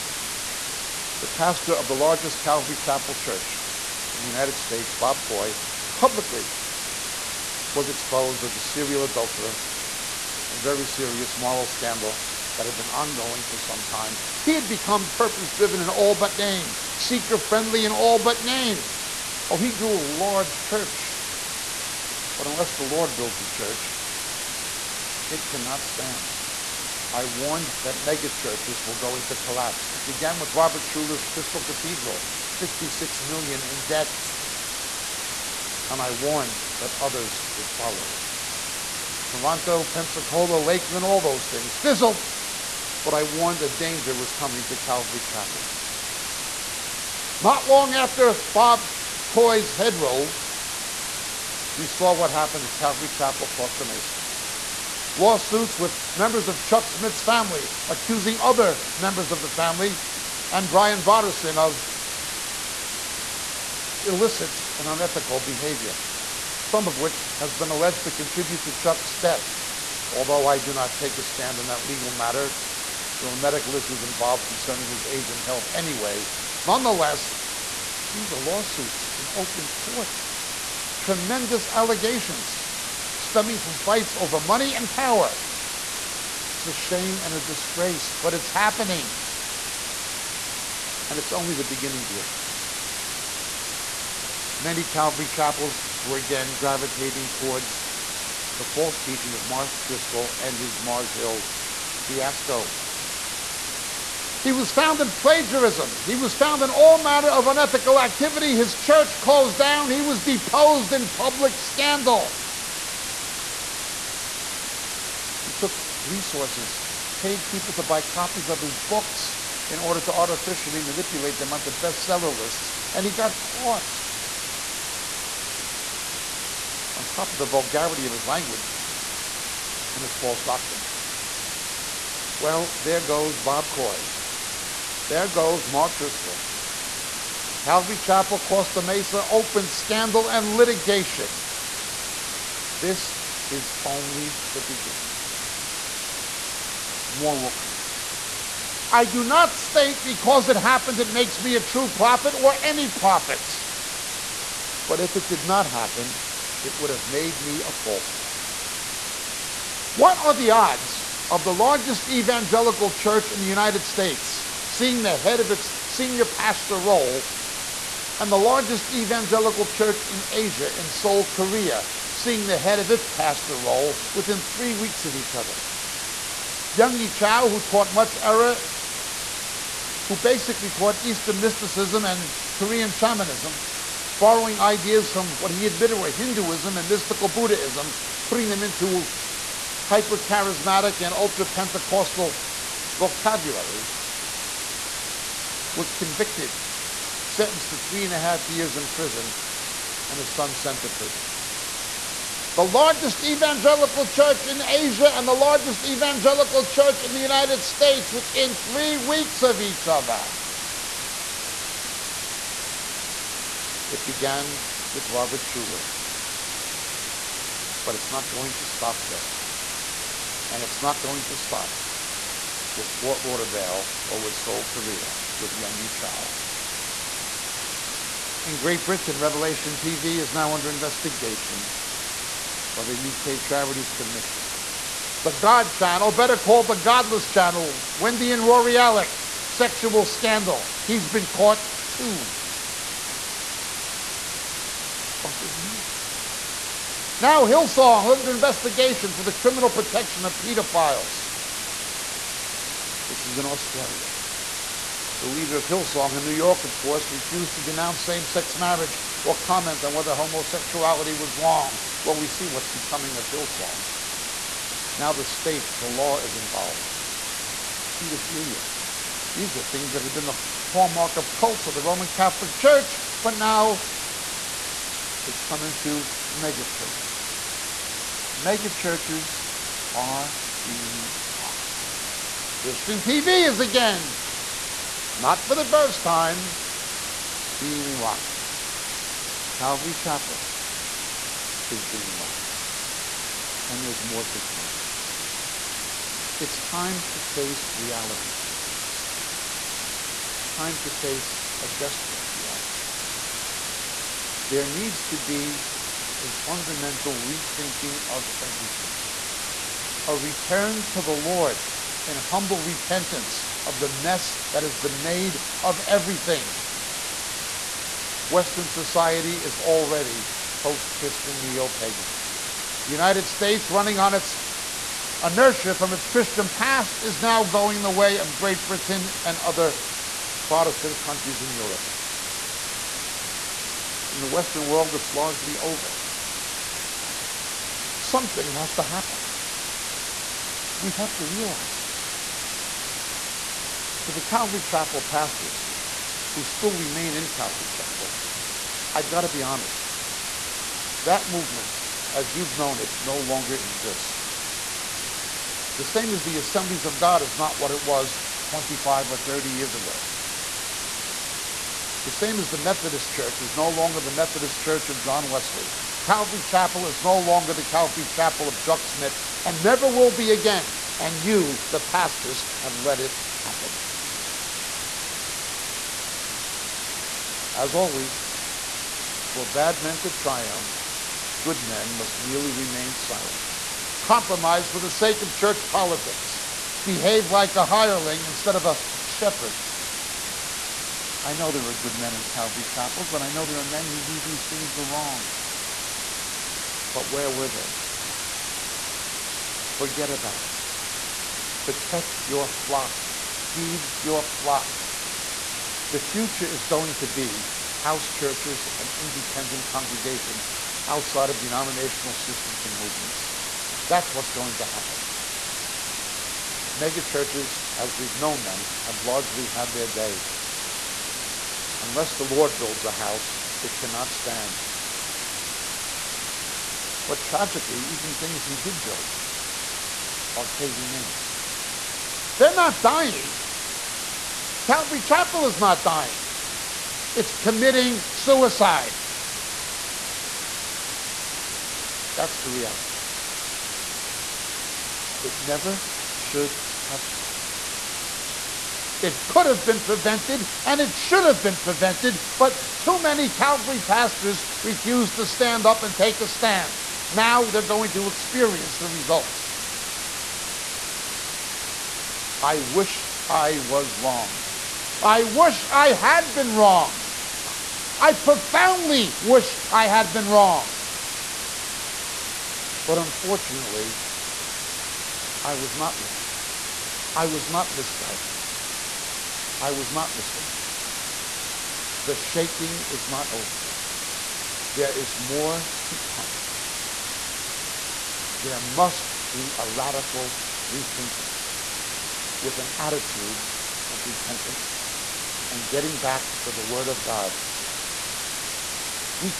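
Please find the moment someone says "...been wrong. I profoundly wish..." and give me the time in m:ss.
7:46.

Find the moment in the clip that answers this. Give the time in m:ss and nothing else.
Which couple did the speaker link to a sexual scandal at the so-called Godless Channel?
3:57.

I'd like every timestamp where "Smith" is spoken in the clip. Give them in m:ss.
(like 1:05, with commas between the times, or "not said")
0:56, 6:08.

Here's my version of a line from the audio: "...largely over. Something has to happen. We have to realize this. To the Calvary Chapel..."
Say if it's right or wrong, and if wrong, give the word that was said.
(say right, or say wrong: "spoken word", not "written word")
right.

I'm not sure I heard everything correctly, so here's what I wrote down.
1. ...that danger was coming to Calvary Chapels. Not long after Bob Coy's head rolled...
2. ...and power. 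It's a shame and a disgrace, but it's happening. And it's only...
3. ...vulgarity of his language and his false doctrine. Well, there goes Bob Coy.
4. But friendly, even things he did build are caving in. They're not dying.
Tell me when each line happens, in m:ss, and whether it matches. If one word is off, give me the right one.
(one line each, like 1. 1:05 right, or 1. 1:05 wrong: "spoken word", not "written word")
1. 0:43 right
2. 1:24 right
3. 2:07 right
4. 7:07 wrong: "tragically", not "friendly".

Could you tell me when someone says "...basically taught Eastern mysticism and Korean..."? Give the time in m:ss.
3:00.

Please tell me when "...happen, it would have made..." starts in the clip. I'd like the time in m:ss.
2:35.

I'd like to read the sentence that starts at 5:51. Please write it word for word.
That movement, as you've known it, no longer exists.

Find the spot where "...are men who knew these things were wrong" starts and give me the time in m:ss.
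6:33.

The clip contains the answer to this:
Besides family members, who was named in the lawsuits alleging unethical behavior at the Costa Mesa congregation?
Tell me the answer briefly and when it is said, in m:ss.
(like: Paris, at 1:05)
Brian Brodersen, at 1:00.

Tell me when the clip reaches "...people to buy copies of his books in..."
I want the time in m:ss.
1:57.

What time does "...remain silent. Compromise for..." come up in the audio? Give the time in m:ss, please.
6:22.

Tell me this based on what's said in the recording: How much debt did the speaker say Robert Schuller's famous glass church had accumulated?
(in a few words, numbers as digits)
56 million.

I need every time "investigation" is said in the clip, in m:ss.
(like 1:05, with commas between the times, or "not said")
3:50, 4:08.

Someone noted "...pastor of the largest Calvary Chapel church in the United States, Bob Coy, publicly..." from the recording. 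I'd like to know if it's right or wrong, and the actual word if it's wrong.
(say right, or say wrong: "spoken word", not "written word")
right.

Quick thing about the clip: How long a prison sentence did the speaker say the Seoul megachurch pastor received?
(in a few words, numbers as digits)
3.5 years.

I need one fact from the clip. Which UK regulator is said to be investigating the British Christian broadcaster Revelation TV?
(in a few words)
UK Charities Commission.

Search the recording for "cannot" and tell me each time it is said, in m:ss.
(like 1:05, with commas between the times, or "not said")
0:25, 7:03.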